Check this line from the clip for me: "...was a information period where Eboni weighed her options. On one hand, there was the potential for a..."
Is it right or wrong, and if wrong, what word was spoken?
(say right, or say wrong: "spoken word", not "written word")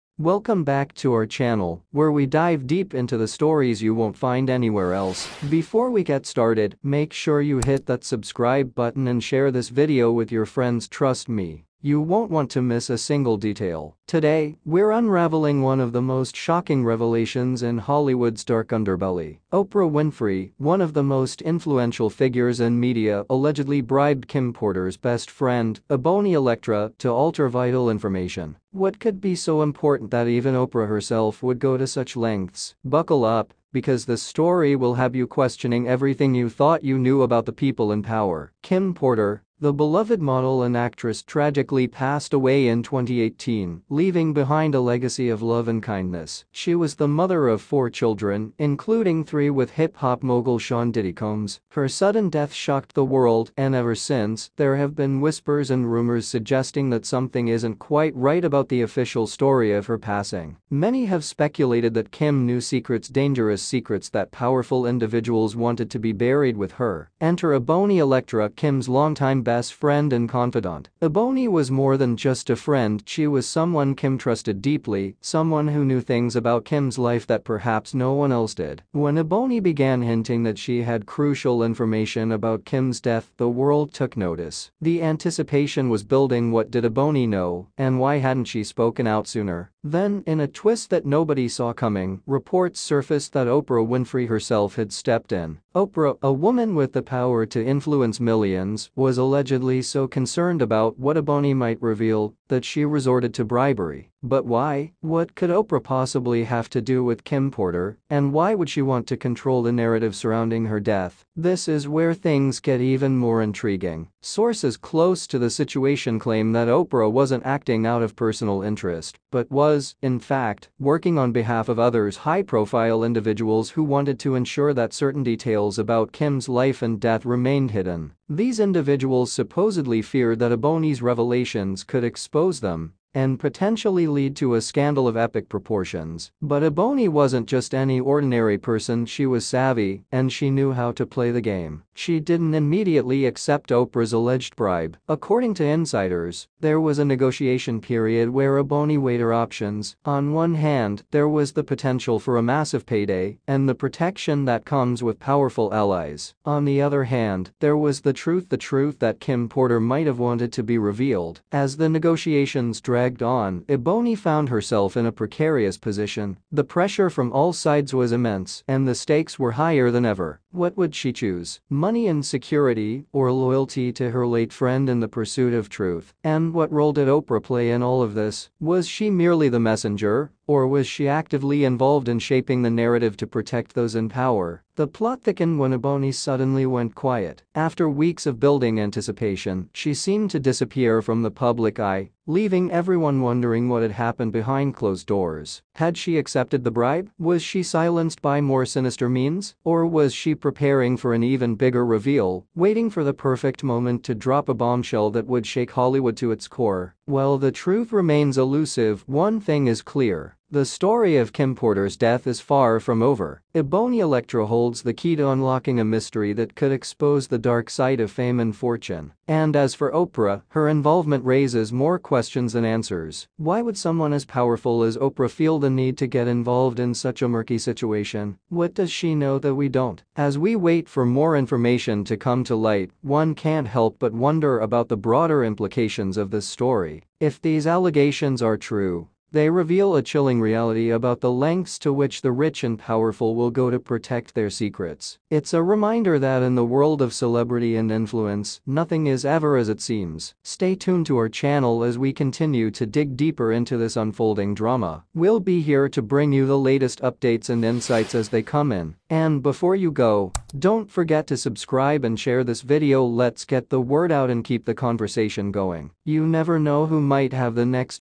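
wrong: "negotiation", not "information".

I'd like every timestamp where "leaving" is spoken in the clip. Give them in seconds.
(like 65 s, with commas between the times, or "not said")
43 s, 192 s.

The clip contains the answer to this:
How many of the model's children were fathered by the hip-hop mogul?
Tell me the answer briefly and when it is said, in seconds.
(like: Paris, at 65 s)
3, at 49 s.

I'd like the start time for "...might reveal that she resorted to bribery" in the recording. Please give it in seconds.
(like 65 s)
101 s.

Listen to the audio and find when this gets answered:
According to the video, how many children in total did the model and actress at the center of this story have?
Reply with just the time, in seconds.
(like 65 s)
47 s.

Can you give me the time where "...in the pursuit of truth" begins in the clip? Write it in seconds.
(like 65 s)
174 s.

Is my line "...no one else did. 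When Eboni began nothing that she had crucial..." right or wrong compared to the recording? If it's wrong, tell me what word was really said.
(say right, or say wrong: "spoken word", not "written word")
wrong: "hinting", not "nothing".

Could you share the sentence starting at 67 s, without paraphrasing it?
Enter Eboni Elektra, Kim's longtime best friend and confidant.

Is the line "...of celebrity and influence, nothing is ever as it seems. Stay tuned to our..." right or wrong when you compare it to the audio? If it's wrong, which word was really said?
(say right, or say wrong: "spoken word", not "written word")
right.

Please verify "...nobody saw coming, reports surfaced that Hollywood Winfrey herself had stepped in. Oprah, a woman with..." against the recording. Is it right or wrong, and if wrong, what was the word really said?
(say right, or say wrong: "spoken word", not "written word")
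wrong: "Oprah", not "Hollywood".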